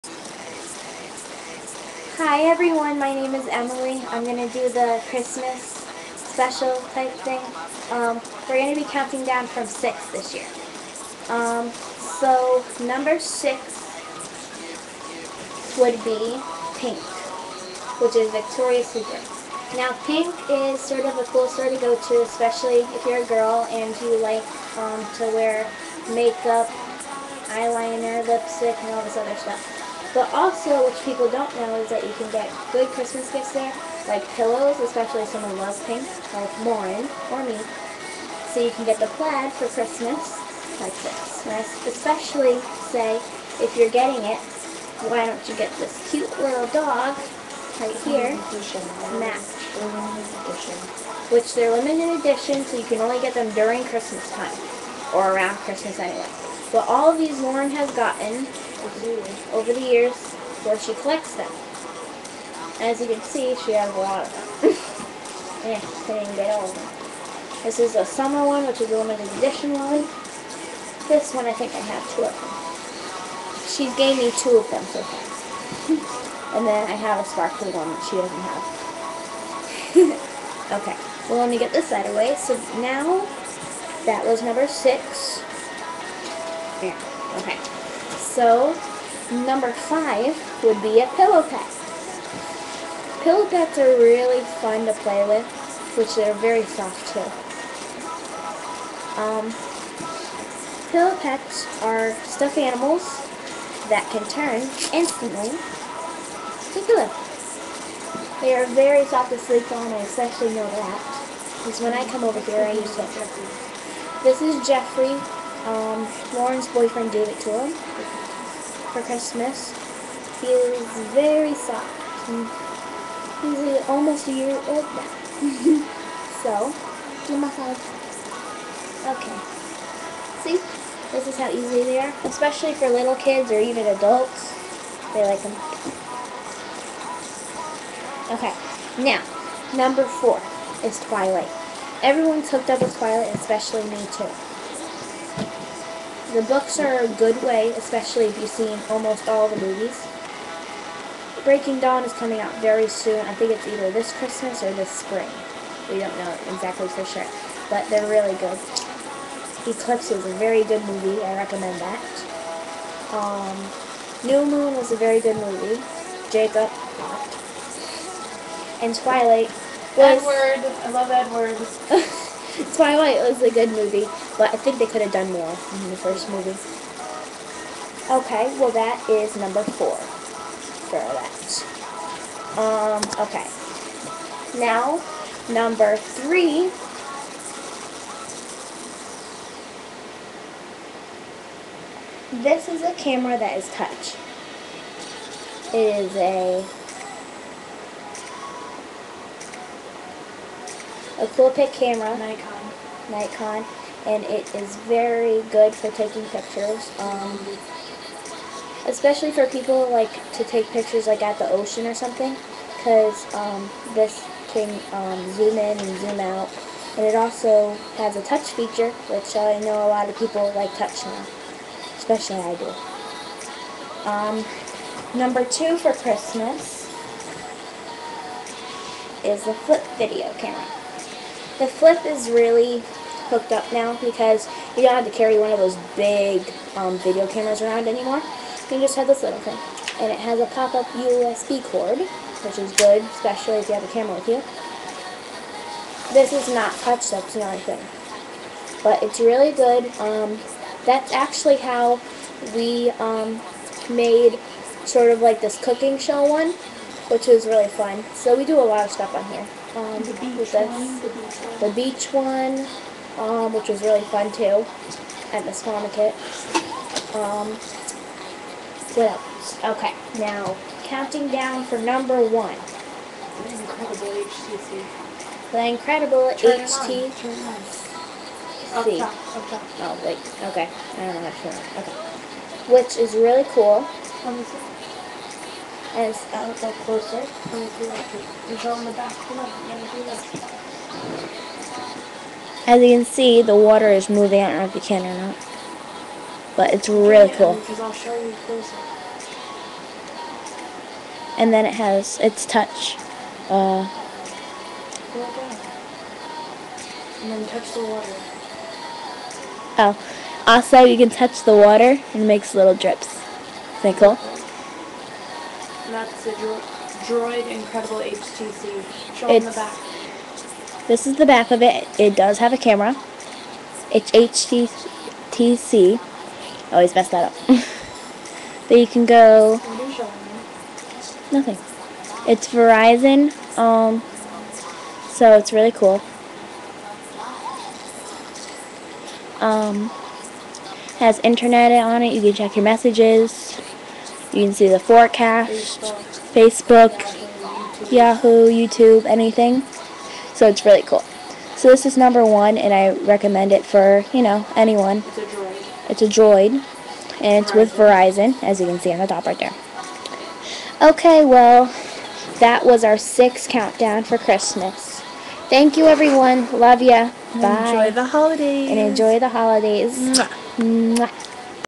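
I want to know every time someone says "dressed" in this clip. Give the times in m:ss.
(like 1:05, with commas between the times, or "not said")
not said.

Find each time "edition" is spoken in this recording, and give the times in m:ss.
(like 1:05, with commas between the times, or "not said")
0:52, 1:09.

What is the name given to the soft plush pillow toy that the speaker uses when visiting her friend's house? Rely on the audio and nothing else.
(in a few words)
Jeffrey.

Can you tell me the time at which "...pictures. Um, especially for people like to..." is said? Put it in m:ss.
3:26.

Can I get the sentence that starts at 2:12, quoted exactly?
Especially for little kids or even adults.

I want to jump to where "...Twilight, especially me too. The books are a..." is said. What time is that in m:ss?
2:22.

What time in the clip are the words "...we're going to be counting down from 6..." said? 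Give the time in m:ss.
0:08.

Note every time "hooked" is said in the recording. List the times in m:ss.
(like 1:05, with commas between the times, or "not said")
2:22, 3:53.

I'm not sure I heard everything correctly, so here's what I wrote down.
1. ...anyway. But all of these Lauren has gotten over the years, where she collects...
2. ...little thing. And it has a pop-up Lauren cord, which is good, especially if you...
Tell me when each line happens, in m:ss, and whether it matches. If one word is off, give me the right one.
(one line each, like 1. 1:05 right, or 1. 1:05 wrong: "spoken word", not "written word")
1. 0:55 right
2. 3:59 wrong: "USB", not "Lauren".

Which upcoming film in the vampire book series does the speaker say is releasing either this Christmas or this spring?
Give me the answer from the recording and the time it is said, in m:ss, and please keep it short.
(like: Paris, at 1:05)
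Breaking Dawn, at 2:31.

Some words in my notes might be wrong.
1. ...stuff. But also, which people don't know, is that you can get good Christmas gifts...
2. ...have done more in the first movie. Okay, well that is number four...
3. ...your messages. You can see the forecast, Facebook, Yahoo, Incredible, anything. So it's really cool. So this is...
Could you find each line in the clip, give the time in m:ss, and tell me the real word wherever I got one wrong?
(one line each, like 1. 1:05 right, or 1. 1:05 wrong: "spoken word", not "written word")
1. 0:29 right
2. 2:55 right
3. 5:42 wrong: "YouTube", not "Incredible".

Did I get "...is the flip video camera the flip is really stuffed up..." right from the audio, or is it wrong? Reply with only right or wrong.
wrong.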